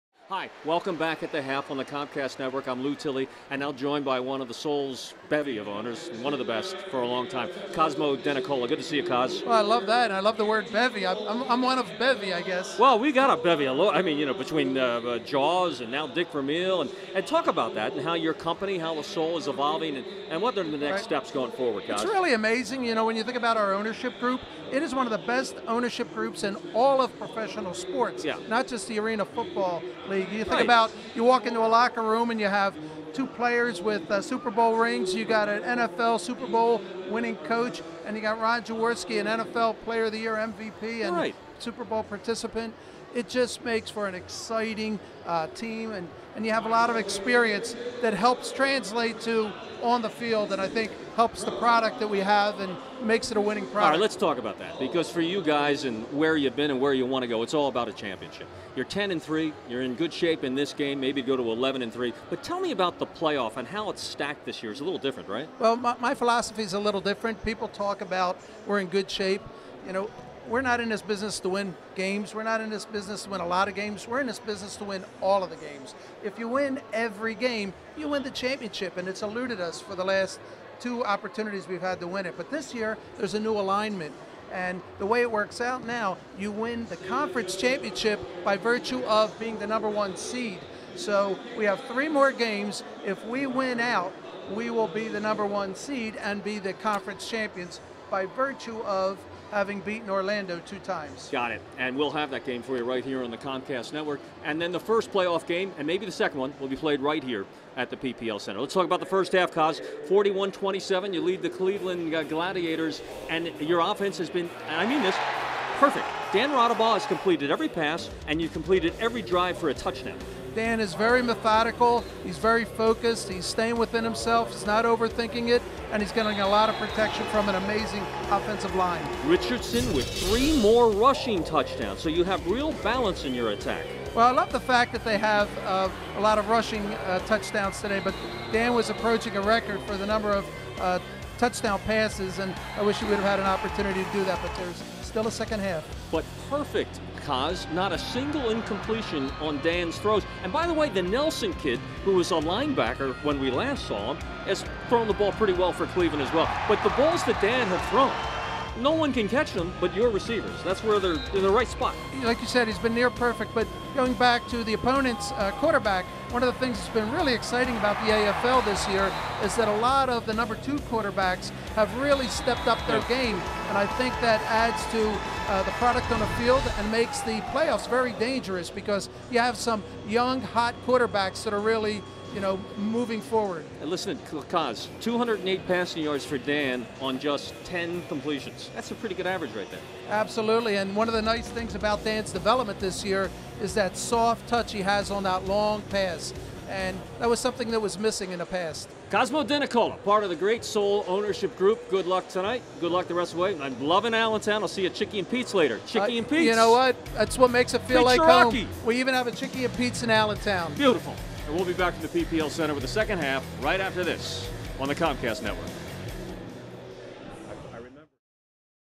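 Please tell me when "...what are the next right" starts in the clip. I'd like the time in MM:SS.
00:20.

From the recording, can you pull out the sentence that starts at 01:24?
And the way it works out now, you win the conference championship by virtue of being the number one seed.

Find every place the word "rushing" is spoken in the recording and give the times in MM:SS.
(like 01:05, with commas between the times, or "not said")
02:10, 02:16.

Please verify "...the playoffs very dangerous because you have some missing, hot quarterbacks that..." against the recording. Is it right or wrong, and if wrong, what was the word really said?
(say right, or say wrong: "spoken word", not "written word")
wrong: "young", not "missing".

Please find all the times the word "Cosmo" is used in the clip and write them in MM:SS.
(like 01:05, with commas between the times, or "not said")
00:07, 03:19.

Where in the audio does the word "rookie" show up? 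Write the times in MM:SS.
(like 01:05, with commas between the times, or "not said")
not said.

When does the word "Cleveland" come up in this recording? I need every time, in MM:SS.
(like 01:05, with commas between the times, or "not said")
01:51, 02:35.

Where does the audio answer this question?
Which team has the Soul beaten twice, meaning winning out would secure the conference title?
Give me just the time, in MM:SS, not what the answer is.
01:40.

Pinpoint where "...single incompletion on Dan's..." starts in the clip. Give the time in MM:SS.
02:27.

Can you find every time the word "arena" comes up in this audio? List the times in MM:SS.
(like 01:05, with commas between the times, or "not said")
00:28.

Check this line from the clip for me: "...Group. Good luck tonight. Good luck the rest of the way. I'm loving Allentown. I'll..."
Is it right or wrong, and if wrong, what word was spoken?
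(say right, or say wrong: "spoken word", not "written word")
right.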